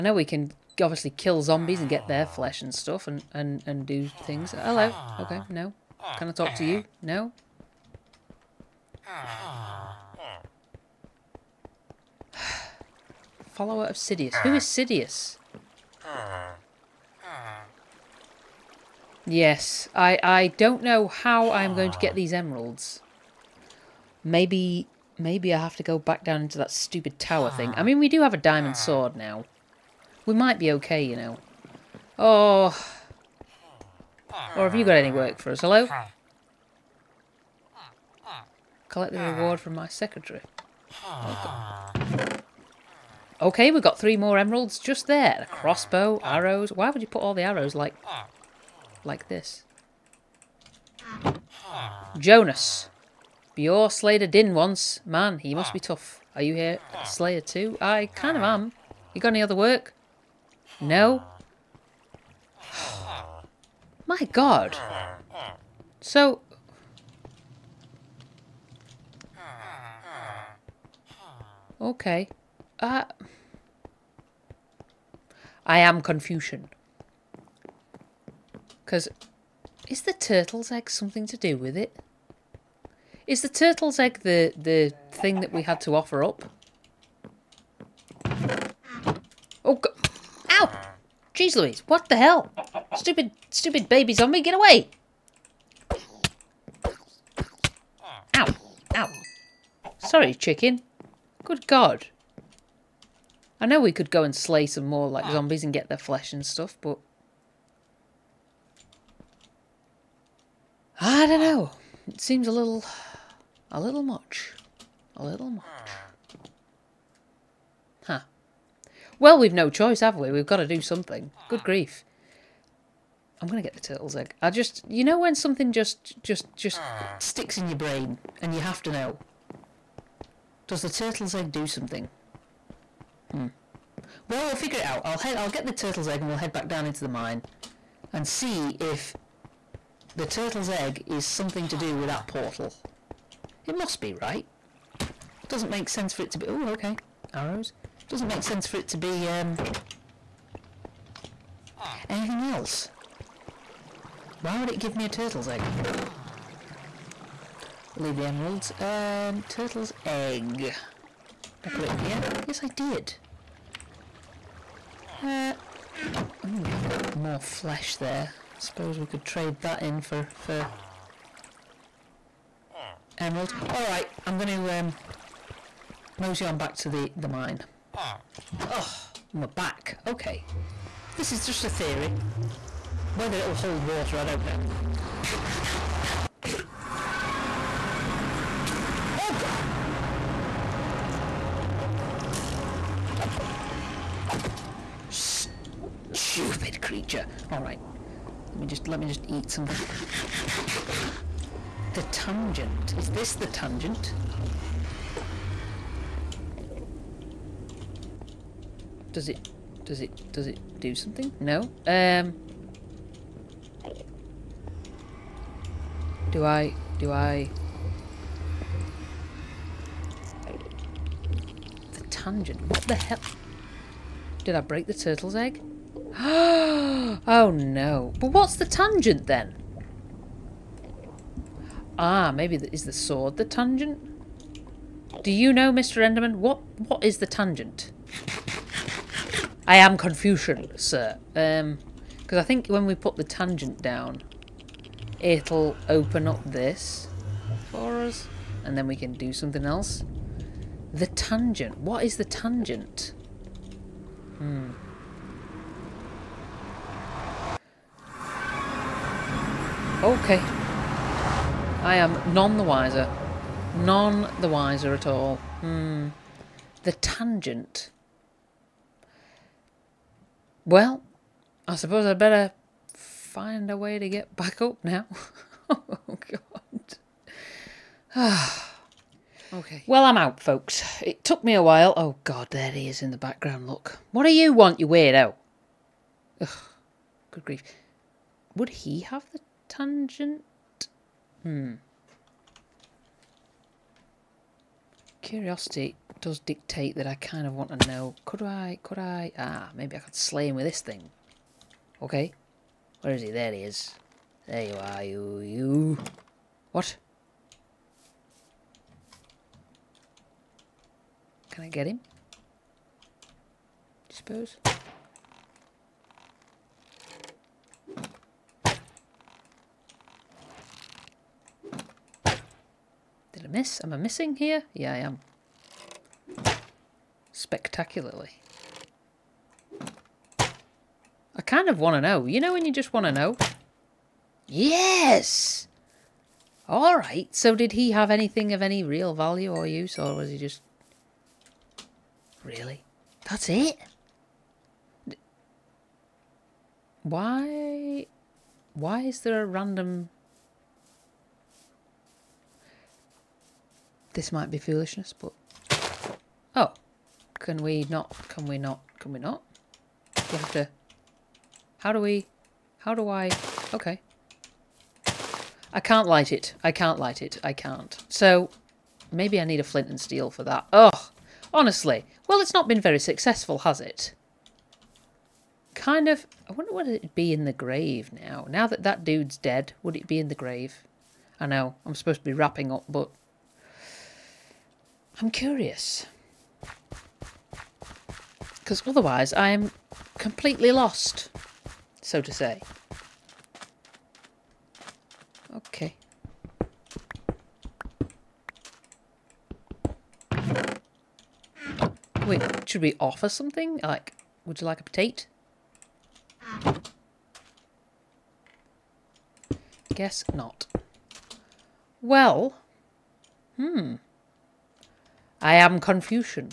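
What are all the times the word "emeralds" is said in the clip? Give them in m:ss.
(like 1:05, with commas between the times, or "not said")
0:22, 0:44, 2:38, 2:53.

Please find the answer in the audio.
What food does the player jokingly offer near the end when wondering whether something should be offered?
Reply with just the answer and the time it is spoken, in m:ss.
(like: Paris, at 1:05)
potato, at 6:44.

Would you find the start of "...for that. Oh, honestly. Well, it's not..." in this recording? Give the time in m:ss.
6:10.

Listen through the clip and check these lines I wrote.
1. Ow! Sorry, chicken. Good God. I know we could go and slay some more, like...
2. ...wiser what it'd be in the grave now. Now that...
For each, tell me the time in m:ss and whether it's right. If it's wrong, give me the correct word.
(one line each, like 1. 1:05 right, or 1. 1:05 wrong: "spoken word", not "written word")
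1. 1:38 right
2. 6:16 wrong: "wonder", not "wiser".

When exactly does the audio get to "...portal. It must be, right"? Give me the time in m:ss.
2:22.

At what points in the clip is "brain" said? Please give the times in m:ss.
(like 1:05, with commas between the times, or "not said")
2:07.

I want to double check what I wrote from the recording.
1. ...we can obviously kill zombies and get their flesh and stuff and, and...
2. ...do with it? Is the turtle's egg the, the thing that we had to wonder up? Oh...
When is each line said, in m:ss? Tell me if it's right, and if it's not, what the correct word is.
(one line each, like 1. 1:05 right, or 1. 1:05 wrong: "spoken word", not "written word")
1. 0:00 right
2. 1:21 wrong: "offer", not "wonder".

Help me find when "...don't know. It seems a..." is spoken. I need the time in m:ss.
1:51.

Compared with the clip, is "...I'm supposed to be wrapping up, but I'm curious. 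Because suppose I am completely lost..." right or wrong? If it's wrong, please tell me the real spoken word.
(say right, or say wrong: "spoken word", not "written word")
wrong: "otherwise", not "suppose".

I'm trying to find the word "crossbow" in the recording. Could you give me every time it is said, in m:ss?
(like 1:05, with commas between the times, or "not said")
0:45.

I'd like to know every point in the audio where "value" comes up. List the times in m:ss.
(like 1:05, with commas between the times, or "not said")
5:39.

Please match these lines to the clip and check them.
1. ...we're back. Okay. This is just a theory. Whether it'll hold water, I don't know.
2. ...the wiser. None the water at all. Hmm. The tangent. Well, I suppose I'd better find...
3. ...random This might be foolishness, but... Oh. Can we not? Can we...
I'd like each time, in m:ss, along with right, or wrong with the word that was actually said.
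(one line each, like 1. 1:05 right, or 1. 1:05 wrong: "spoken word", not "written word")
1. 2:59 right
2. 4:22 wrong: "wiser", not "water"
3. 5:49 right.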